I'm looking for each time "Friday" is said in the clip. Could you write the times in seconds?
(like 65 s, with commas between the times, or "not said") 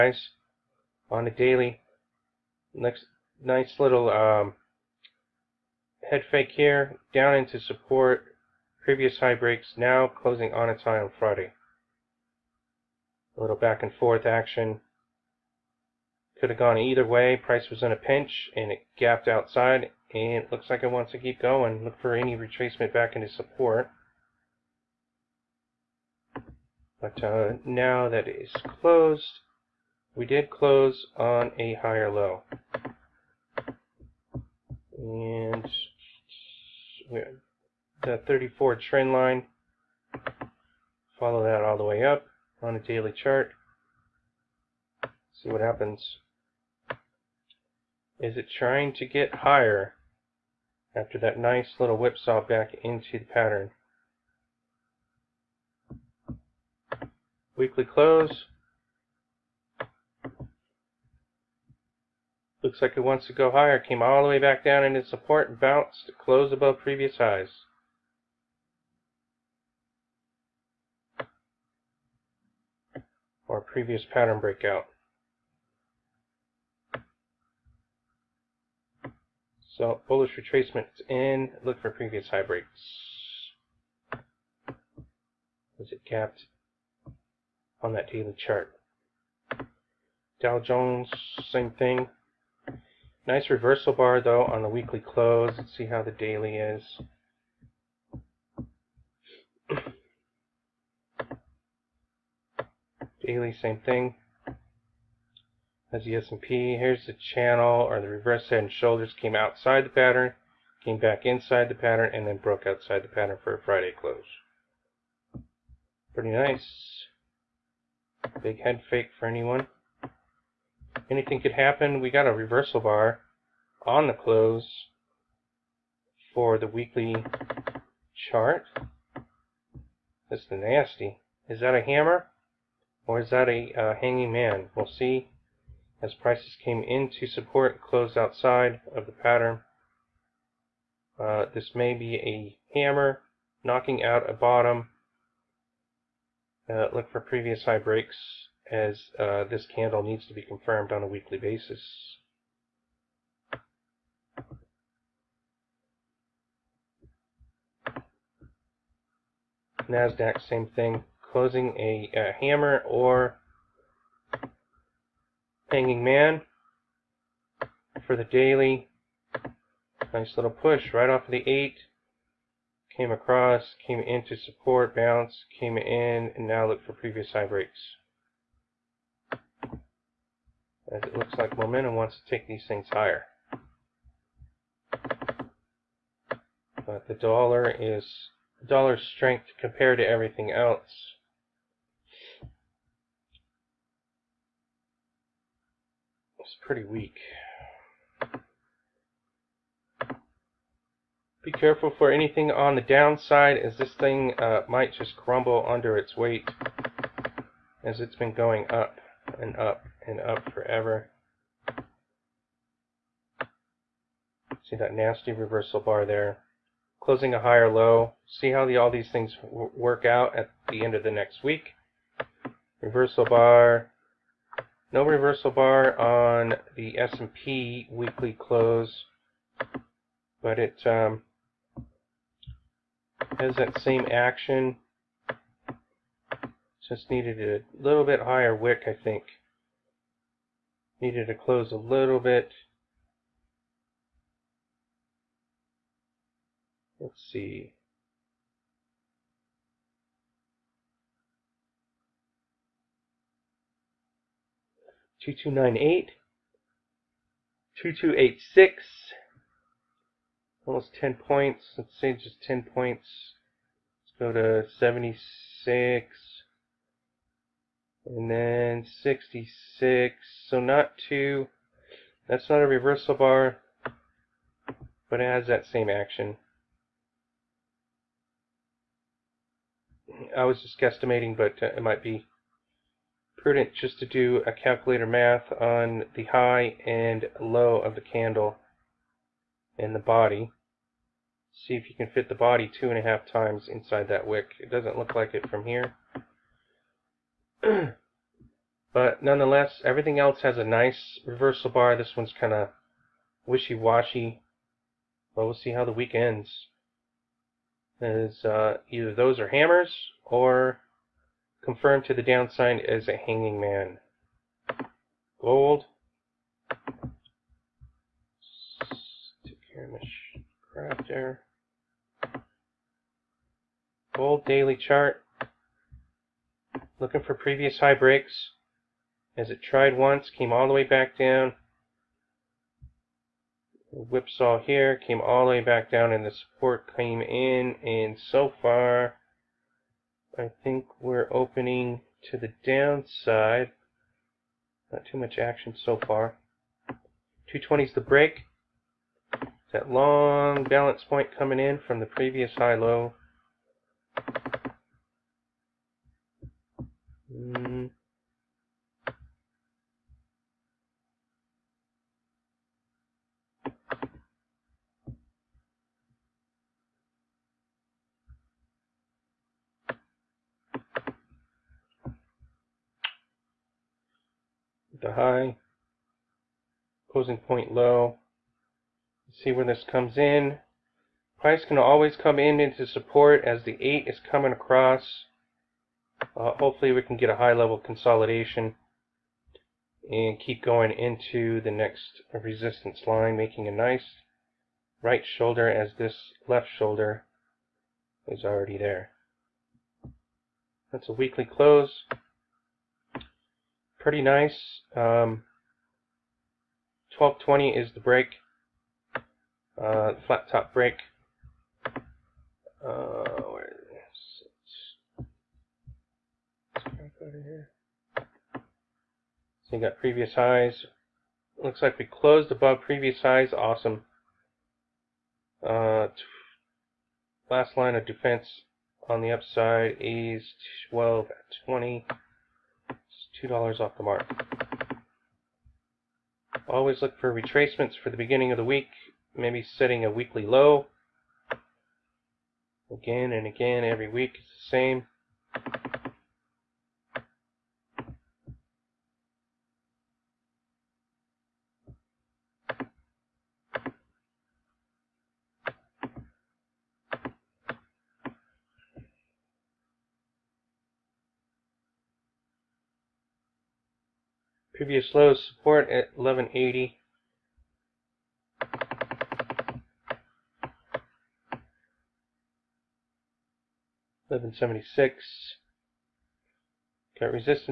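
11 s, 113 s.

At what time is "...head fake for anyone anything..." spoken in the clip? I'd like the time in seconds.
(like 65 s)
118 s.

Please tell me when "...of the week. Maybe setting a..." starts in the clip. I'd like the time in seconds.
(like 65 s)
438 s.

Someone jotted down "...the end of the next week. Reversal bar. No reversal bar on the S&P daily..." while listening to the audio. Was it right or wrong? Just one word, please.
wrong.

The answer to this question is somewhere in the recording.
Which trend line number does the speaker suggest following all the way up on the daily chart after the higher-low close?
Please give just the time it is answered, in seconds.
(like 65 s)
38 s.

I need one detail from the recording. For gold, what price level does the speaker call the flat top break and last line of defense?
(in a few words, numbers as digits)
1220.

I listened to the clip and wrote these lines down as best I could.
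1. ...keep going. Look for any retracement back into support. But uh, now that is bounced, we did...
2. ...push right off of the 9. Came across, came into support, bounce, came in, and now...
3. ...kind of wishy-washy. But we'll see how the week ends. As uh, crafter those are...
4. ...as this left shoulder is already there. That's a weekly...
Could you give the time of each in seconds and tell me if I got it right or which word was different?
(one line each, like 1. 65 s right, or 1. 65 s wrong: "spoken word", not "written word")
1. 21 s wrong: "closed", not "bounced"
2. 170 s wrong: "8", not "9"
3. 302 s wrong: "either", not "crafter"
4. 395 s right.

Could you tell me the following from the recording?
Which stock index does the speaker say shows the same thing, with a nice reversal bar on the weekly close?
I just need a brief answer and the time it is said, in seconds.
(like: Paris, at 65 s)
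Dow Jones, at 90 s.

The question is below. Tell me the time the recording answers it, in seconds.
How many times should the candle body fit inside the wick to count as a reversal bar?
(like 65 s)
292 s.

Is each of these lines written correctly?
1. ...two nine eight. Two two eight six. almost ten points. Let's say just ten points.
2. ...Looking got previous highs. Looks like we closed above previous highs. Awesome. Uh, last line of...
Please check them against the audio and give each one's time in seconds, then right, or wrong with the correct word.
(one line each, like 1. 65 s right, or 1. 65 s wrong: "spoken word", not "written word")
1. 255 s right
2. 419 s right.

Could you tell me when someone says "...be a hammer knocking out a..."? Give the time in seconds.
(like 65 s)
141 s.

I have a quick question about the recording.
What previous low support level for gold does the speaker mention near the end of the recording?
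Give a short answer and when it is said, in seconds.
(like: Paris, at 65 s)
1180, at 466 s.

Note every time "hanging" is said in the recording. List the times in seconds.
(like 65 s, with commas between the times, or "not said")
133 s, 165 s, 313 s.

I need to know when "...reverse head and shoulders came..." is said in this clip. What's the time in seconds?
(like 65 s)
108 s.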